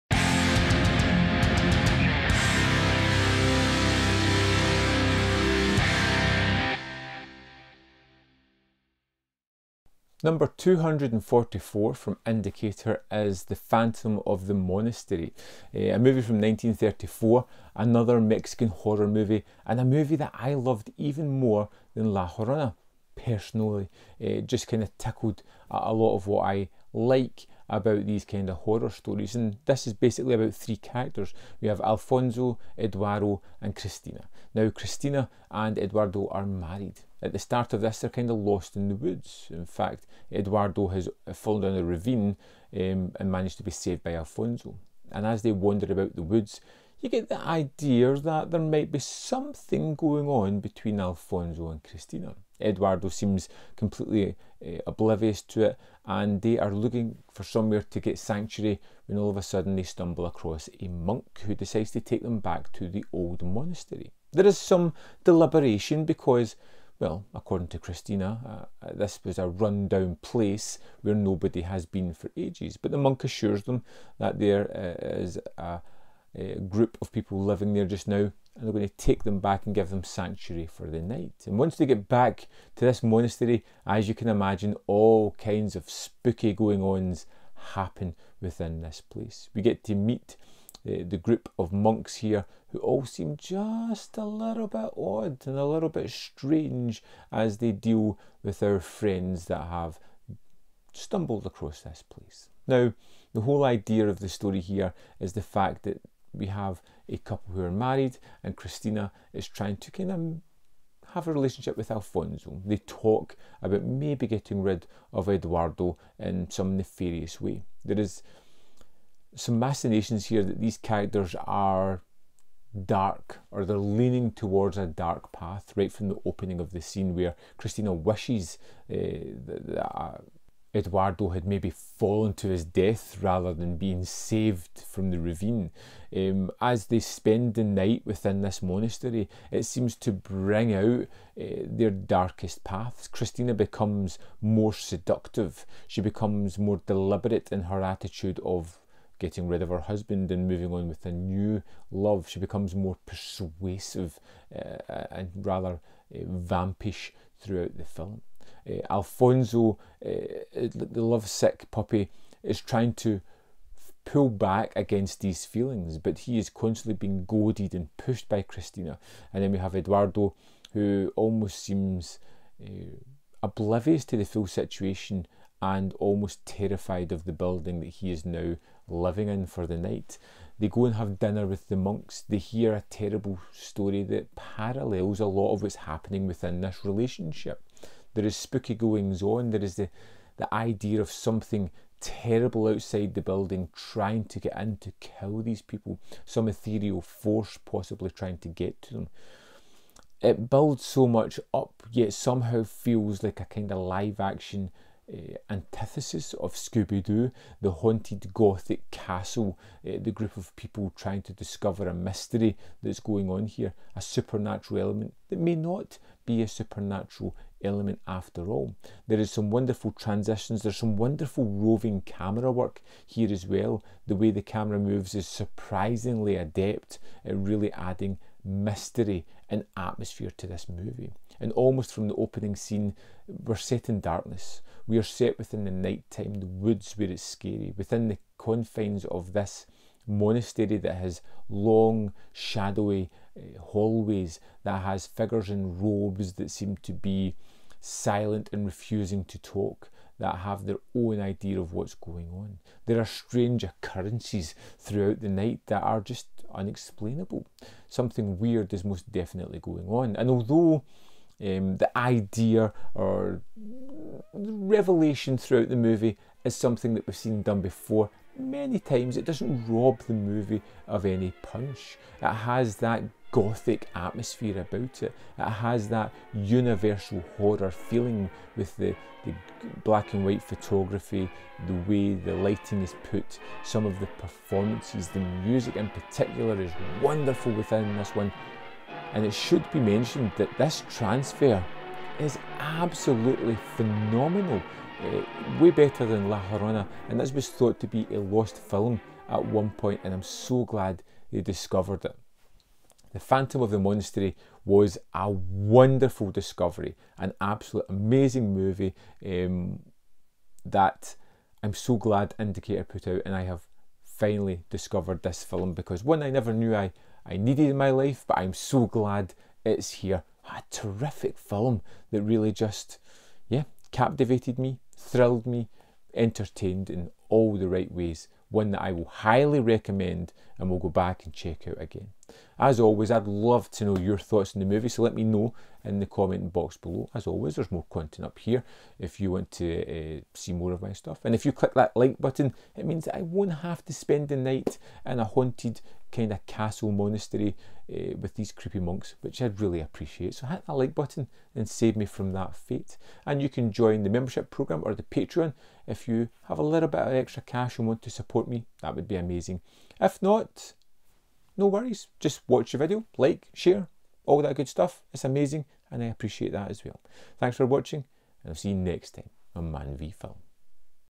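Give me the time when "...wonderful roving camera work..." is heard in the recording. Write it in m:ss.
3:40.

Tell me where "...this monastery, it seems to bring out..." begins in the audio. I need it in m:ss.
2:18.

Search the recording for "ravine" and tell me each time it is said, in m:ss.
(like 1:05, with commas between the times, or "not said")
0:41, 2:15.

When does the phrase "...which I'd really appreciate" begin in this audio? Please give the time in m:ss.
5:49.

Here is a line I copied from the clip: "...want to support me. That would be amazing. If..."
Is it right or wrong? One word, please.
right.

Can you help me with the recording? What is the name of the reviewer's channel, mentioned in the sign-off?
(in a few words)
Man v Film.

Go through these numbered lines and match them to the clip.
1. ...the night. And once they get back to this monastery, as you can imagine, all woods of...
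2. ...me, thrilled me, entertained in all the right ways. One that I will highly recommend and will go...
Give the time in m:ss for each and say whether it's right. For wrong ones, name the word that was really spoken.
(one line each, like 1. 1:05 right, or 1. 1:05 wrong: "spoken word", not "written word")
1. 1:20 wrong: "kinds", not "woods"
2. 5:24 right.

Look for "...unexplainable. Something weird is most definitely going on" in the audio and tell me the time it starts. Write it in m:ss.
4:16.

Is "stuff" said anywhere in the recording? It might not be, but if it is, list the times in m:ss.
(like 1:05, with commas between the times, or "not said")
5:40, 6:04.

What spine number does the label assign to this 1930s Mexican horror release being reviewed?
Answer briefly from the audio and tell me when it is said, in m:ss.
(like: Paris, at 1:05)
244, at 0:10.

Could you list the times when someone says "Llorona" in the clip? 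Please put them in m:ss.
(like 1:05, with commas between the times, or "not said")
0:22, 4:56.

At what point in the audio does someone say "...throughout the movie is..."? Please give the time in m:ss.
4:25.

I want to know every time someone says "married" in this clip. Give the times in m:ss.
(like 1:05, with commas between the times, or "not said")
0:36, 1:47.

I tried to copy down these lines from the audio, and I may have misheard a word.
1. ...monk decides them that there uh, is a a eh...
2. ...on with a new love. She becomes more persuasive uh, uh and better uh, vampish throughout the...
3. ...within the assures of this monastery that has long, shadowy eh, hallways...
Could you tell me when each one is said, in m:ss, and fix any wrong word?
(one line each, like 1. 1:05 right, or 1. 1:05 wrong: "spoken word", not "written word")
1. 1:12 wrong: "assures", not "decides"
2. 2:30 wrong: "rather", not "better"
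3. 3:57 wrong: "confines", not "assures".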